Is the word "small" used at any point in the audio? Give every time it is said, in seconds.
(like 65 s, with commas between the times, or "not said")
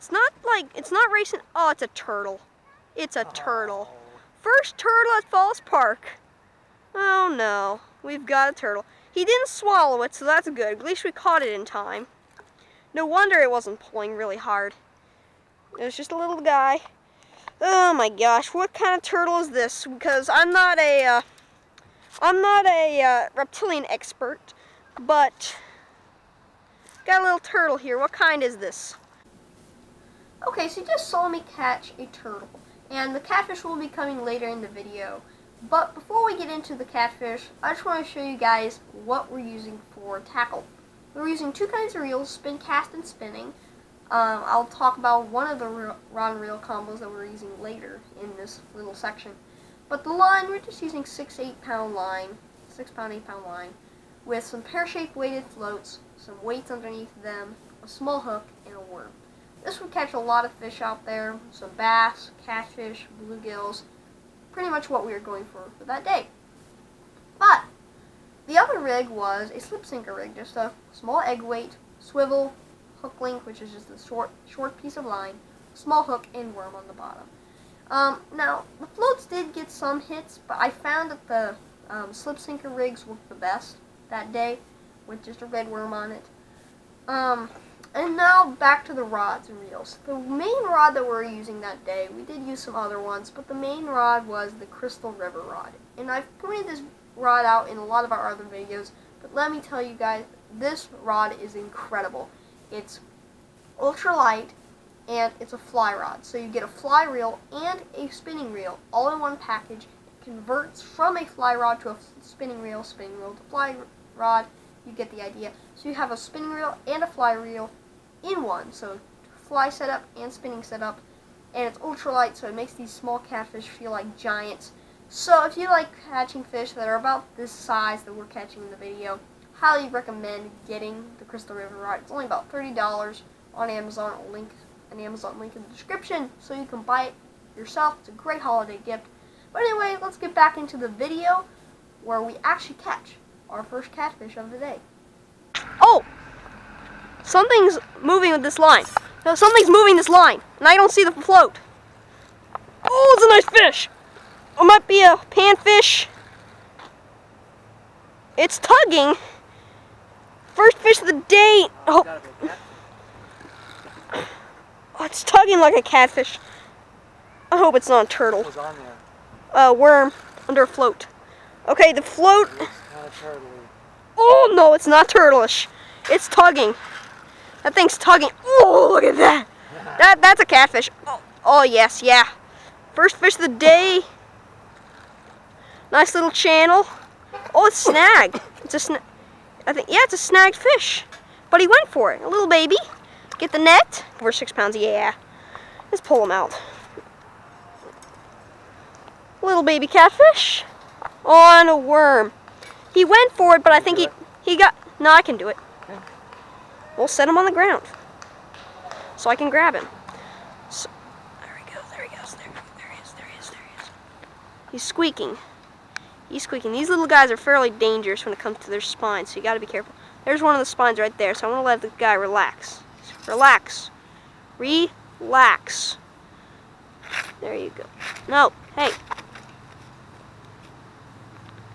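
57 s, 70 s, 75 s, 122 s.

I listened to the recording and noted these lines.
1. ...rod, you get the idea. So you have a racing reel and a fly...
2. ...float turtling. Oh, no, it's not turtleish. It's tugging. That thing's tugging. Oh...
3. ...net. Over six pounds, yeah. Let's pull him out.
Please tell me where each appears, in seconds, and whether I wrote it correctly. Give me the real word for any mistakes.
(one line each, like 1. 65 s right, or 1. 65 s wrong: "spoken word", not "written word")
1. 114 s wrong: "spinning", not "racing"
2. 172 s right
3. 193 s right.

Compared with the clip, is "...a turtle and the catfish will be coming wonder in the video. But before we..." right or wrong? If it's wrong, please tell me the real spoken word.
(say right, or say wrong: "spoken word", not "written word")
wrong: "later", not "wonder".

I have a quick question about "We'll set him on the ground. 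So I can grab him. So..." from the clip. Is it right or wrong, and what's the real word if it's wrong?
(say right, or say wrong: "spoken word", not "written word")
right.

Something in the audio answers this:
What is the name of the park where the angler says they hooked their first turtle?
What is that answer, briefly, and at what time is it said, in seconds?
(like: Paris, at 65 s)
Falls Park, at 5 s.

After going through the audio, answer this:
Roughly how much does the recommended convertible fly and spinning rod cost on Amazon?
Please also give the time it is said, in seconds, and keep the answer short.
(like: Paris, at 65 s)
$30, at 132 s.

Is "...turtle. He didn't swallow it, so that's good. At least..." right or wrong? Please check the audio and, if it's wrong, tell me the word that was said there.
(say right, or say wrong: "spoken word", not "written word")
right.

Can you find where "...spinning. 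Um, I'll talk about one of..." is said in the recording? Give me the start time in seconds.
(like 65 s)
43 s.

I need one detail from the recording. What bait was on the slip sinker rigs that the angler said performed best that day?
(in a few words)
red worm.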